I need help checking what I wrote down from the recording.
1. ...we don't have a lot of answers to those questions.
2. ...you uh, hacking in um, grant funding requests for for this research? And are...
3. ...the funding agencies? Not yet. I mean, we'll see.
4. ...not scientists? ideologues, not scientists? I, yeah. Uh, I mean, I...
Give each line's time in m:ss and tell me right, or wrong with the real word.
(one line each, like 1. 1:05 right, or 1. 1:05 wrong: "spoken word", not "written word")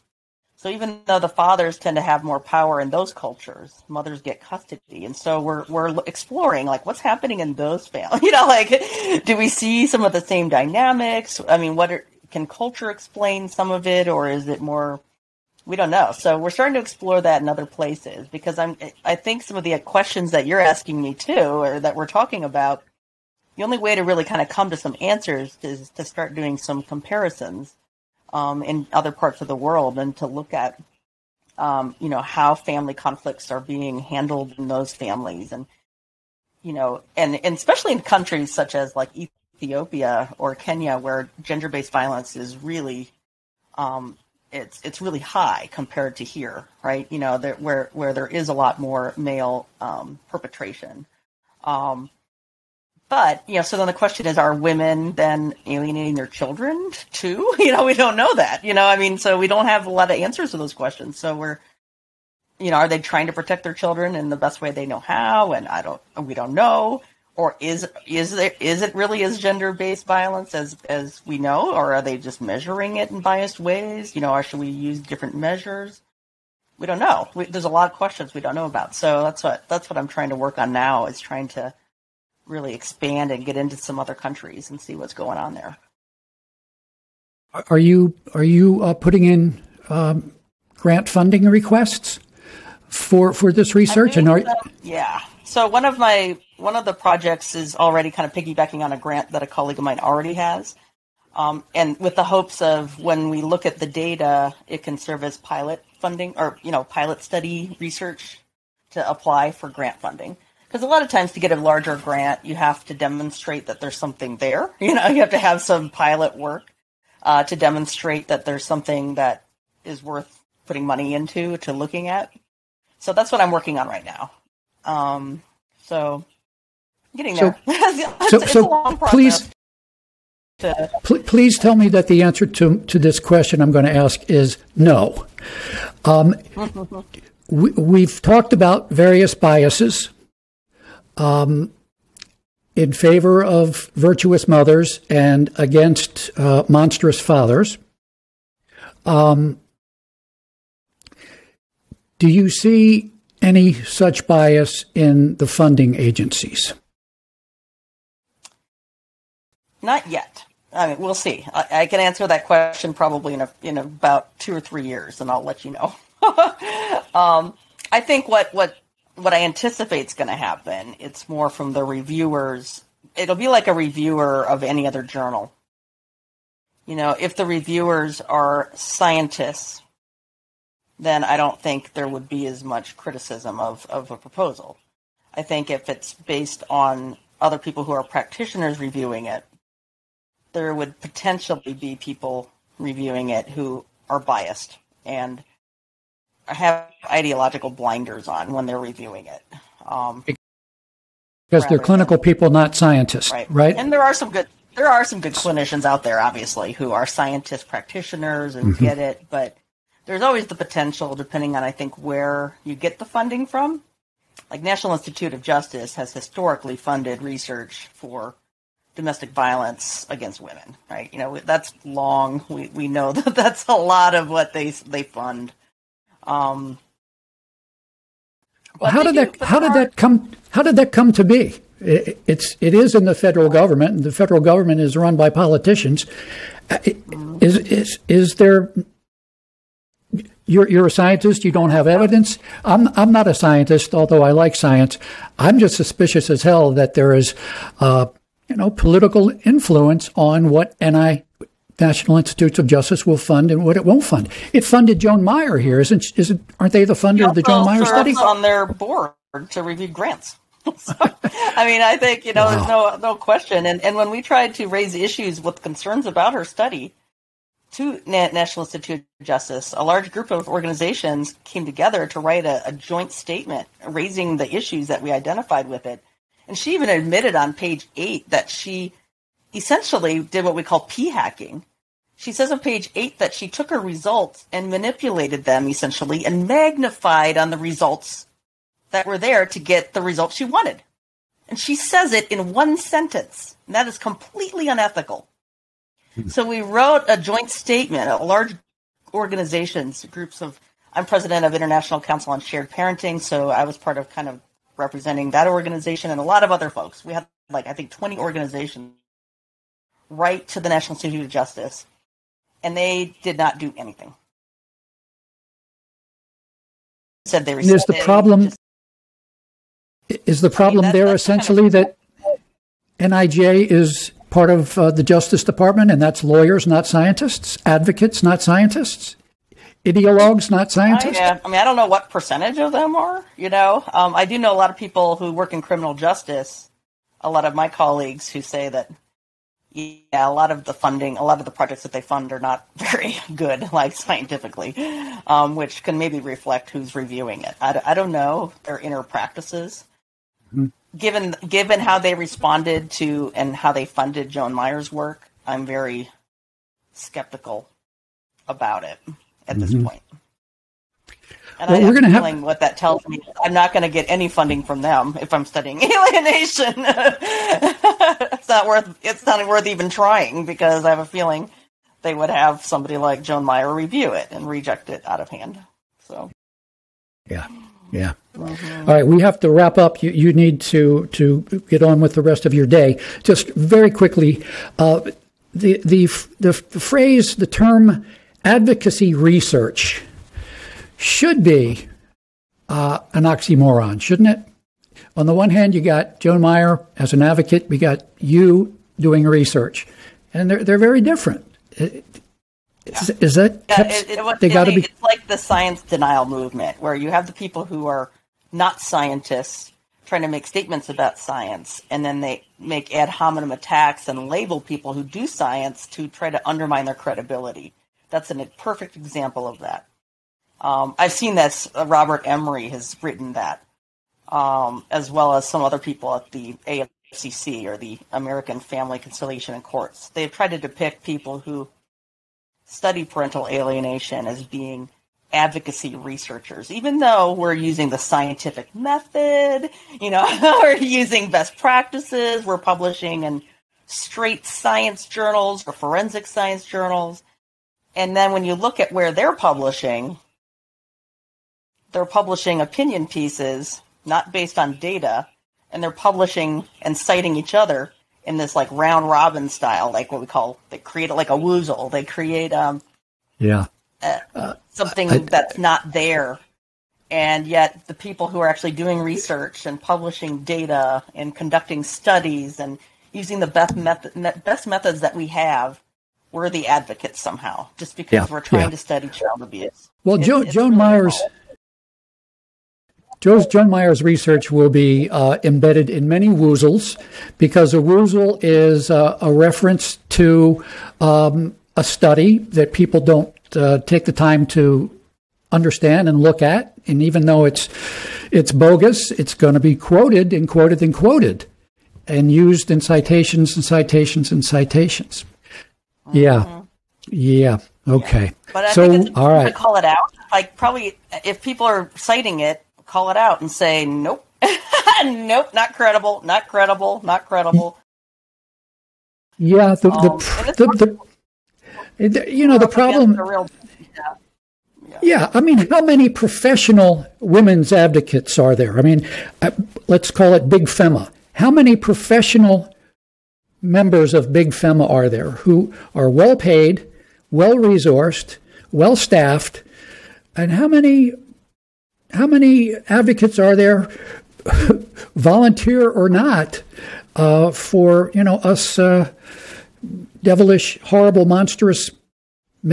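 1. 0:59 right
2. 1:28 wrong: "putting", not "hacking"
3. 2:35 right
4. 5:28 right.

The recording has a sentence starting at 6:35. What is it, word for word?
On the one hand, you got Joan Meier as an advocate, we got you doing research, and they're, they're very different.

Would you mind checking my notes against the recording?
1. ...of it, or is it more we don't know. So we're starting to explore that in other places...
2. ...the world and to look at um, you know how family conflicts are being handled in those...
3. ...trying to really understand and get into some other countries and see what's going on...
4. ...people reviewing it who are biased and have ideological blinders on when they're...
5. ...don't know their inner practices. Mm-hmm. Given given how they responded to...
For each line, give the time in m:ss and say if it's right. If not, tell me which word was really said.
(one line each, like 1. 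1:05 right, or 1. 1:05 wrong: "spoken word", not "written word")
1. 0:13 right
2. 0:29 right
3. 1:21 wrong: "expand", not "understand"
4. 3:11 right
5. 5:47 right.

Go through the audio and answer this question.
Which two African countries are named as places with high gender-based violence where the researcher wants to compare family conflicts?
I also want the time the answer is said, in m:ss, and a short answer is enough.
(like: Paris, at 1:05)
Ethiopia or Kenya, at 0:39.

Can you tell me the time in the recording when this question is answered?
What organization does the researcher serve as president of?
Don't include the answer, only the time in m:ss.
5:01.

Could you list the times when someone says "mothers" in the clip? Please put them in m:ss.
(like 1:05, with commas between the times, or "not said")
0:03, 2:24.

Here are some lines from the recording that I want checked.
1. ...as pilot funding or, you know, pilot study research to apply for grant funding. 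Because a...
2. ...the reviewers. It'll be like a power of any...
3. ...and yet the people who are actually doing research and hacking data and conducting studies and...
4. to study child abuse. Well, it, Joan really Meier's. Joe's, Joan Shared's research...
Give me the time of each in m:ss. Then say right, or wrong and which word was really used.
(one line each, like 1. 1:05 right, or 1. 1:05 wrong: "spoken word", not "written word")
1. 1:45 right
2. 2:51 wrong: "reviewer", not "power"
3. 7:47 wrong: "publishing", not "hacking"
4. 7:58 wrong: "Meier", not "Shared".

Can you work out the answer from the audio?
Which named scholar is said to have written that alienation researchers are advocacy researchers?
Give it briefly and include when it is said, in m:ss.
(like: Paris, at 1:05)
Robert Emery, at 7:01.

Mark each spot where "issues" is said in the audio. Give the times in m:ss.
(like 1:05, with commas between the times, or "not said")
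4:24, 4:34.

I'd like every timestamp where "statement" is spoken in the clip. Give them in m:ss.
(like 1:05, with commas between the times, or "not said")
4:33, 4:57, 6:50.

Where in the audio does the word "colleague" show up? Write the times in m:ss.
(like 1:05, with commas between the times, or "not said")
1:39, 5:37.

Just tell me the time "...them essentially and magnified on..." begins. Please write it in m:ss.
4:45.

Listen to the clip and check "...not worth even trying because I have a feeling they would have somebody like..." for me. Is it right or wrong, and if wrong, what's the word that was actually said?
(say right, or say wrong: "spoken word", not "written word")
right.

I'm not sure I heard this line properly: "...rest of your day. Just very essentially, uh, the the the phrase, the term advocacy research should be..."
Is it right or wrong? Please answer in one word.
wrong.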